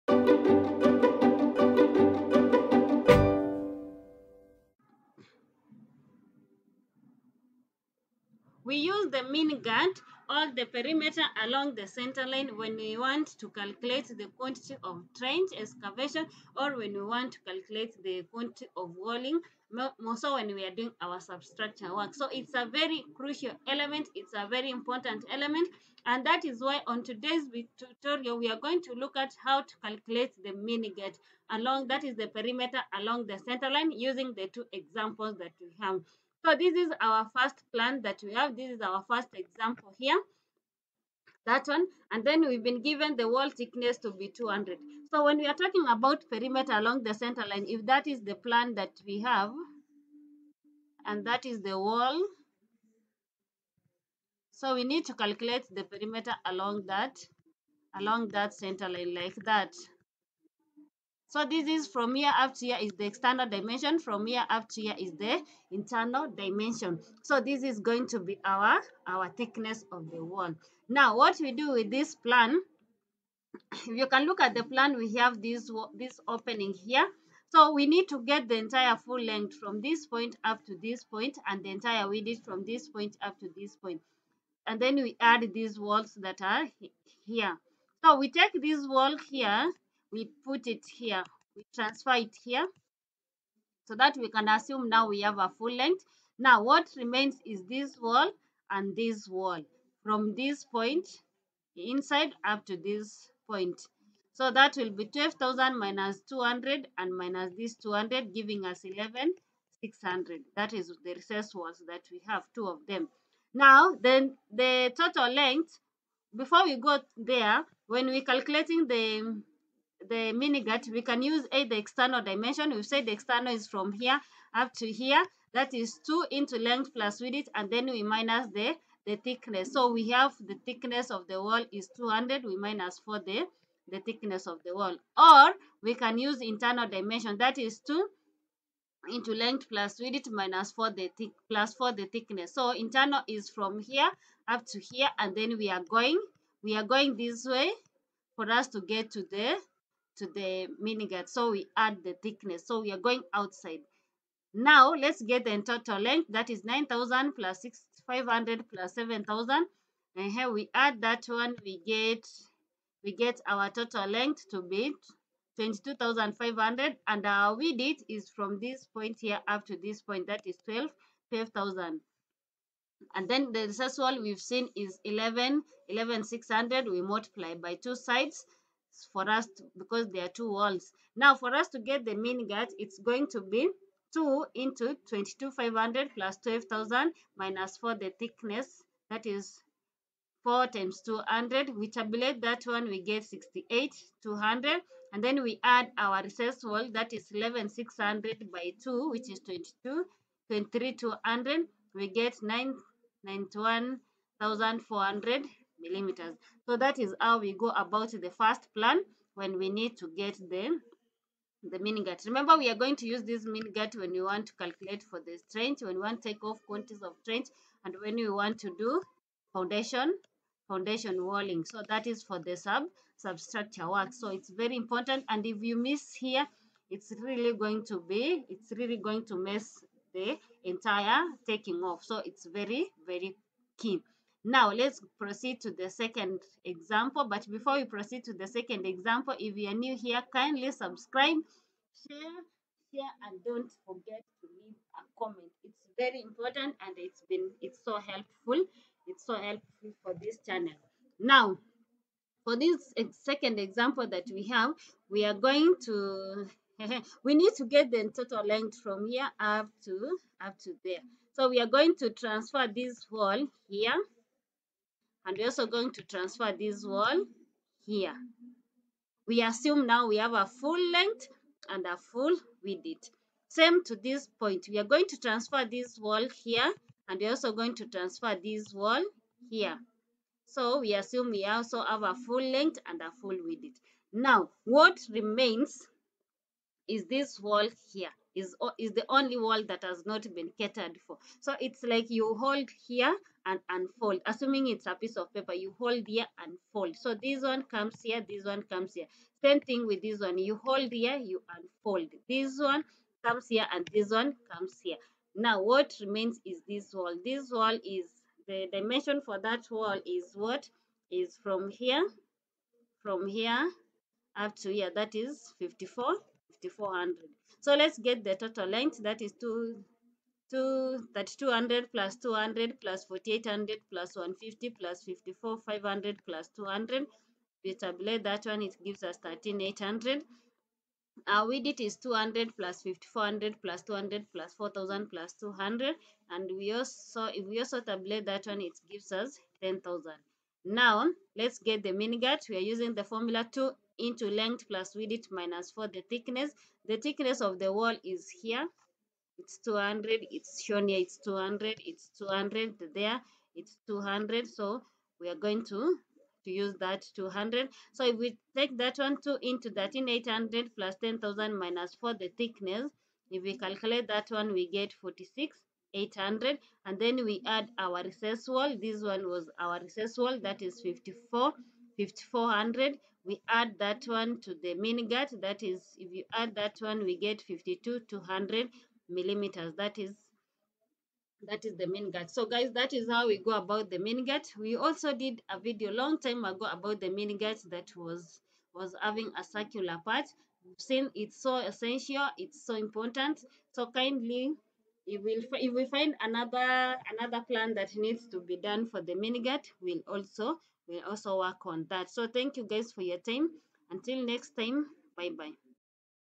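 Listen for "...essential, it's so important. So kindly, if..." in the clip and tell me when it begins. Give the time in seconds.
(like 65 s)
391 s.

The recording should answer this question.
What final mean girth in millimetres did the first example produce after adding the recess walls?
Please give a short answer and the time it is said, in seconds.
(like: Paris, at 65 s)
91,400, at 202 s.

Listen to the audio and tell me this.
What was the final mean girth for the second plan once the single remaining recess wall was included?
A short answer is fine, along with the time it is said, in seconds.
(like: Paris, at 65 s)
52,200 mm, at 377 s.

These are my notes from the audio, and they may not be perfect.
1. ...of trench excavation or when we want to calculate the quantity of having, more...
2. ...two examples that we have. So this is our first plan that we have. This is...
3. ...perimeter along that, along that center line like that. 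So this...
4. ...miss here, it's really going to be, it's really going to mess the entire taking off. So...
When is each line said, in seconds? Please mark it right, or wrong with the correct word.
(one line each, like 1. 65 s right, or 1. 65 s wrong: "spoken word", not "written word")
1. 14 s wrong: "walling", not "having"
2. 34 s right
3. 55 s right
4. 225 s right.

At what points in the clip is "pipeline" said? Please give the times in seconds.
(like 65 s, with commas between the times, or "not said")
not said.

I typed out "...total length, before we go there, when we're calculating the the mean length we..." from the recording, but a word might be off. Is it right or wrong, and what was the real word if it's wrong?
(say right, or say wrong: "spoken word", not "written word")
wrong: "girth", not "length".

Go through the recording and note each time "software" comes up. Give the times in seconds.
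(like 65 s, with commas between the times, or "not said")
not said.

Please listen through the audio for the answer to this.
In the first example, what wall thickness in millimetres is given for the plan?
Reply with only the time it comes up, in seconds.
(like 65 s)
43 s.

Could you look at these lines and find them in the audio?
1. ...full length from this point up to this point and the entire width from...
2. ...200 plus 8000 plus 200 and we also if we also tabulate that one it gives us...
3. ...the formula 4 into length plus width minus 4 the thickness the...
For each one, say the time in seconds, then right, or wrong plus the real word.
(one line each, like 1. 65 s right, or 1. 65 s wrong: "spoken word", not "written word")
1. 78 s right
2. 333 s wrong: "4000", not "8000"
3. 342 s wrong: "2", not "4".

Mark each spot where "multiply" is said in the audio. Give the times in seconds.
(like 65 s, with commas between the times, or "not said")
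177 s.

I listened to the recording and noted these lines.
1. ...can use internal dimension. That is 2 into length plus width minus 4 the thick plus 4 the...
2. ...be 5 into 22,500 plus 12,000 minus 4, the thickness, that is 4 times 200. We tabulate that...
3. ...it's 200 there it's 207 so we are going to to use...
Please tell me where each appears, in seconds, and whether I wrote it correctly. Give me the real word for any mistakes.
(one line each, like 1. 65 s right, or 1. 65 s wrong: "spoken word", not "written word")
1. 135 s right
2. 183 s wrong: "2", not "5"
3. 351 s wrong: "200", not "207".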